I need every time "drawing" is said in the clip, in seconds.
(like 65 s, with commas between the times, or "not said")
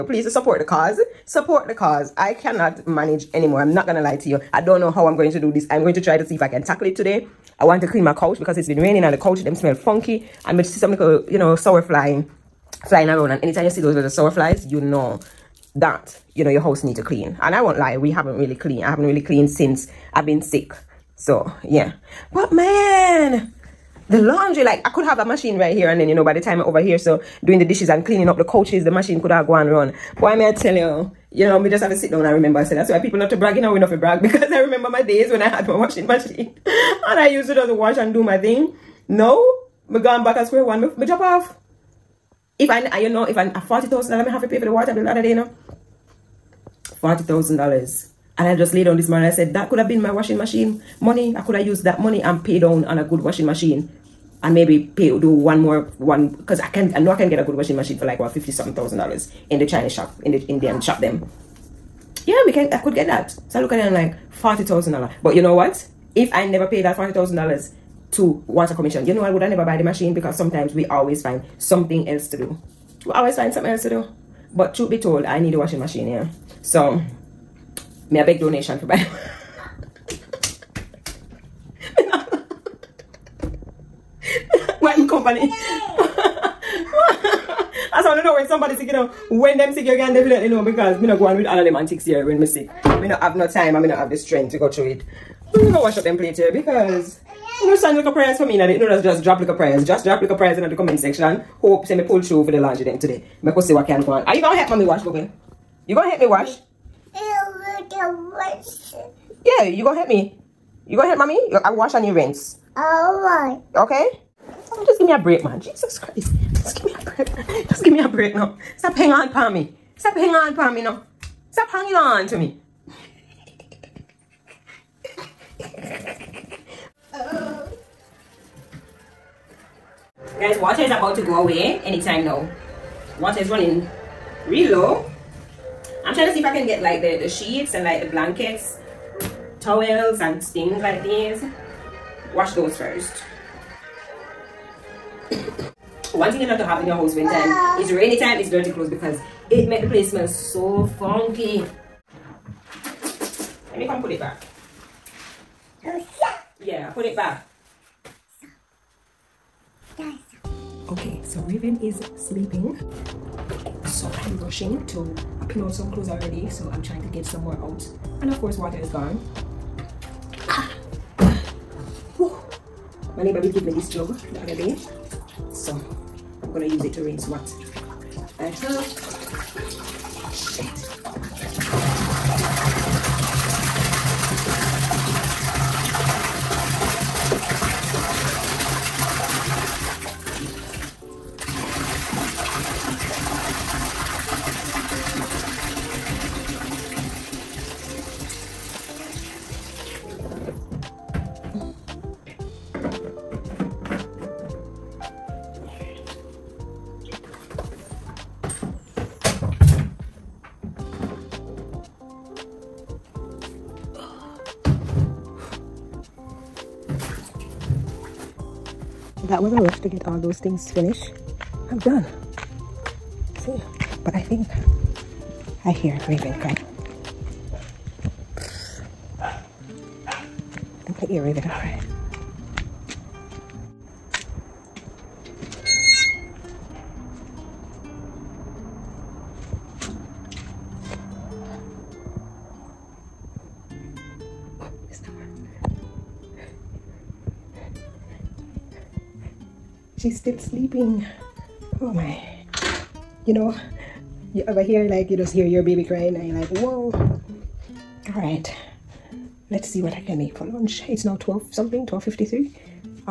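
not said.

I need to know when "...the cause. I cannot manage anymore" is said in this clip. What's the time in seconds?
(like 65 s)
1 s.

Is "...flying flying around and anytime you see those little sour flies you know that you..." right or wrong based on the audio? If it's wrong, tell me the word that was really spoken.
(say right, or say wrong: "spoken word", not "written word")
right.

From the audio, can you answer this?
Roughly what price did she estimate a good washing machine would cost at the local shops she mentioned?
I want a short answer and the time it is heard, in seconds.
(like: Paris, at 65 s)
fifty something thousand dollars, at 58 s.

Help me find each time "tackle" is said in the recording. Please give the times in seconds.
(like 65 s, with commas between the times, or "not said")
6 s.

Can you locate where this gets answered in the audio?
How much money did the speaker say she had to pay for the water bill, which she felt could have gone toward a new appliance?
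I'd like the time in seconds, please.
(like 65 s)
43 s.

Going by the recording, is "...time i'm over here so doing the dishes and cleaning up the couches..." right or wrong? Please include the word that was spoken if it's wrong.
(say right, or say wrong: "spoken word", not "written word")
right.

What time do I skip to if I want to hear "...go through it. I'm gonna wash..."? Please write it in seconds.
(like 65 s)
94 s.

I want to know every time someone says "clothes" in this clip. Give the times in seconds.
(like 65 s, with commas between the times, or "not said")
148 s, 165 s.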